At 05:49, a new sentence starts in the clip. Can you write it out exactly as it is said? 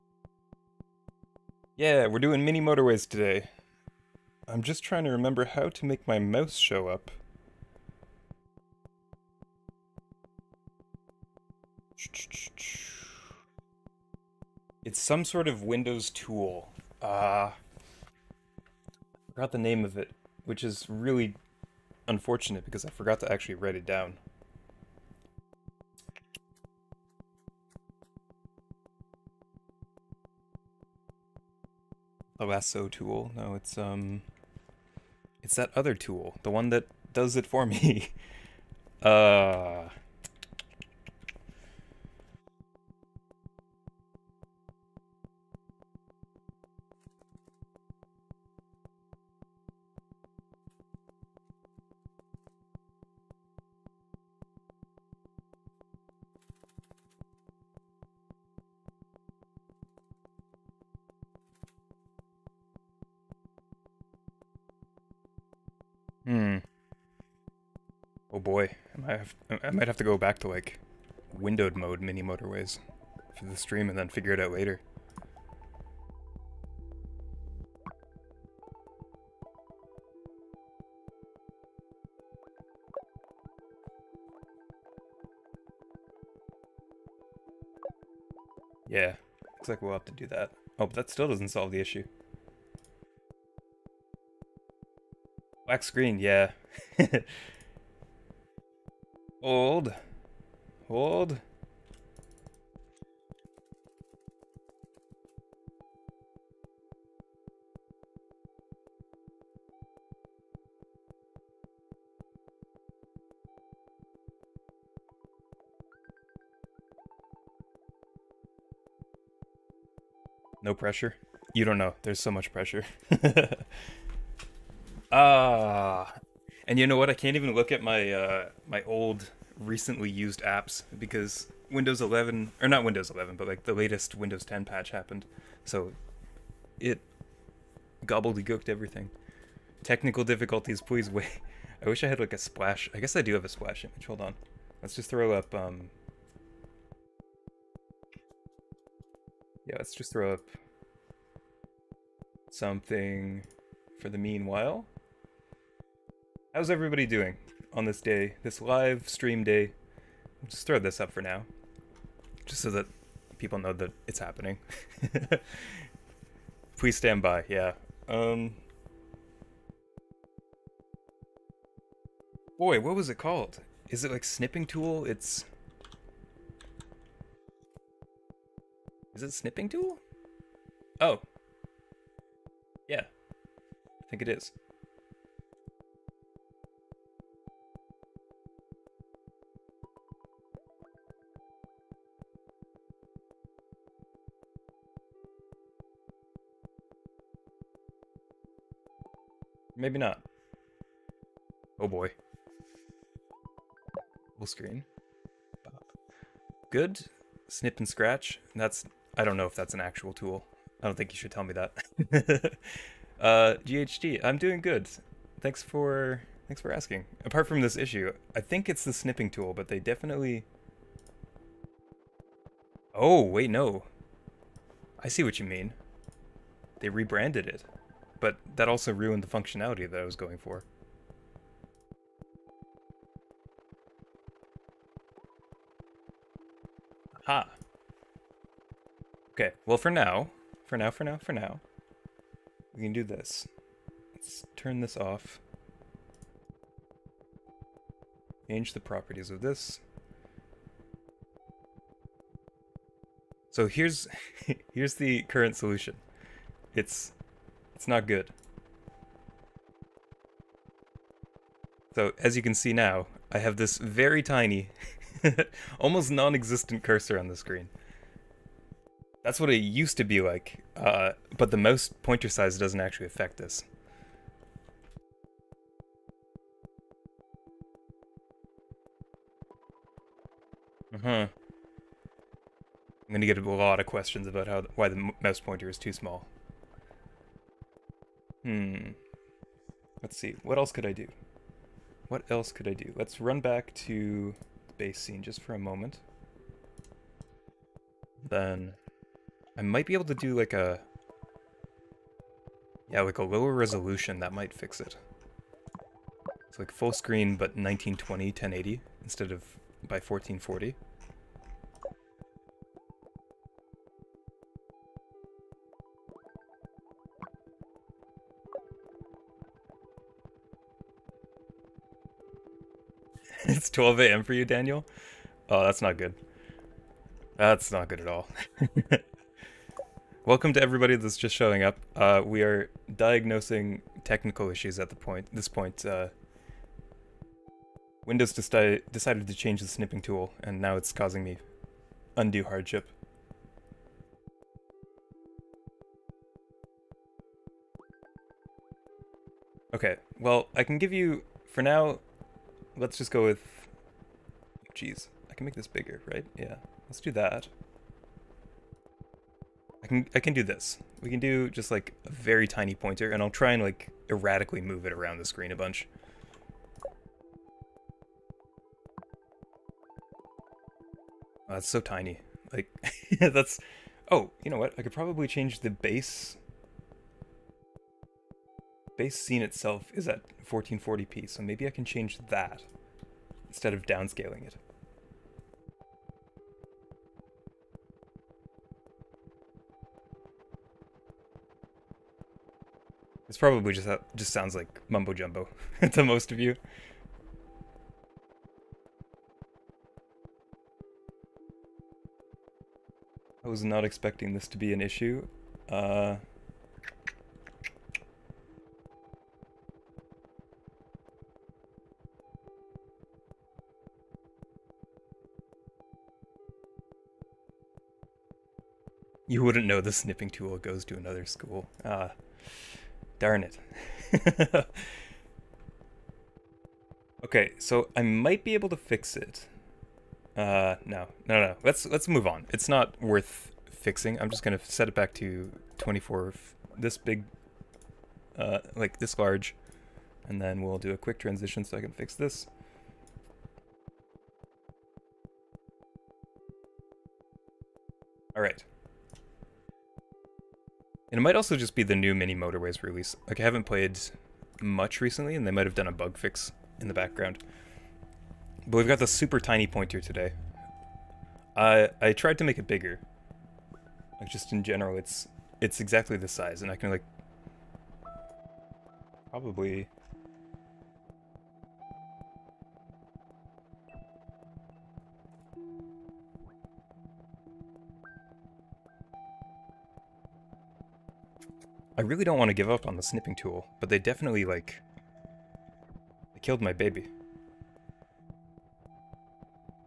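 Okay, well, I can give you, for now, let's just go with Jeez, I can make this bigger, right?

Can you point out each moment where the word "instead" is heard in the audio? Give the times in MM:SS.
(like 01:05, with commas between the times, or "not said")
05:09, 06:23.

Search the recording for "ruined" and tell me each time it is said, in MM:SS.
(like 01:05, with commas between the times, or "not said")
03:48.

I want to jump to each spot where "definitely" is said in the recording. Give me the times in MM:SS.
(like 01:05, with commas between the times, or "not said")
03:39, 08:03.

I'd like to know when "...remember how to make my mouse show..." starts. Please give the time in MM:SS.
00:05.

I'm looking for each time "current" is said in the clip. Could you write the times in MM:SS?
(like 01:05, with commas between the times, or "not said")
04:15.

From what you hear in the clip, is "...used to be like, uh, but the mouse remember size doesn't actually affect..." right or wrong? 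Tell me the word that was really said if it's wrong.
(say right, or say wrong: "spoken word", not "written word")
wrong: "pointer", not "remember".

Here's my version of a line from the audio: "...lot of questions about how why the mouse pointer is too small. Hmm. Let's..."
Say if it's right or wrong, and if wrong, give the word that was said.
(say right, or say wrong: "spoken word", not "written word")
right.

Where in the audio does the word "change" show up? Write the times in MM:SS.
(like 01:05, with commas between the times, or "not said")
04:08, 05:39, 06:15, 06:21.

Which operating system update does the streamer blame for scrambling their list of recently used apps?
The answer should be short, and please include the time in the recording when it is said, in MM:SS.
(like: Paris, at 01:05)
Windows 10, at 02:14.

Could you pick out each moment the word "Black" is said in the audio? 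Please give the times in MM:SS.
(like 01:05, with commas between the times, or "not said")
01:35.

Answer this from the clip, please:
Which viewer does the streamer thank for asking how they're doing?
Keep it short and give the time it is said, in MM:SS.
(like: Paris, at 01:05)
GHD, at 03:33.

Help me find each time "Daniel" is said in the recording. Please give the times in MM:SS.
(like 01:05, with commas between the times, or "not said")
05:24.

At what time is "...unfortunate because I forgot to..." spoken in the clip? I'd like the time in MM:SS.
00:22.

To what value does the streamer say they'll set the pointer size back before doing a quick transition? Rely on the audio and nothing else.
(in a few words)
24.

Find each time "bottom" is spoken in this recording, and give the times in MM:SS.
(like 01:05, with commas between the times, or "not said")
not said.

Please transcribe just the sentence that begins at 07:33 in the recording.
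Like, I haven't played much recently, and they might have done a bug fix in the background.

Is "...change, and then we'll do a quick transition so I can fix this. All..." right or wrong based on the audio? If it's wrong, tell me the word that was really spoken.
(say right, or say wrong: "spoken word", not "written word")
wrong: "large", not "change".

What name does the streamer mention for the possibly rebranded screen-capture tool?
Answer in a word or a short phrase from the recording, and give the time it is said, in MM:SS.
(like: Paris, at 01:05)
Snip and Sketch, at 03:27.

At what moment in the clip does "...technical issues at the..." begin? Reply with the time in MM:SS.
05:34.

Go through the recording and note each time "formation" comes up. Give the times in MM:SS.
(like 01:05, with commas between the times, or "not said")
not said.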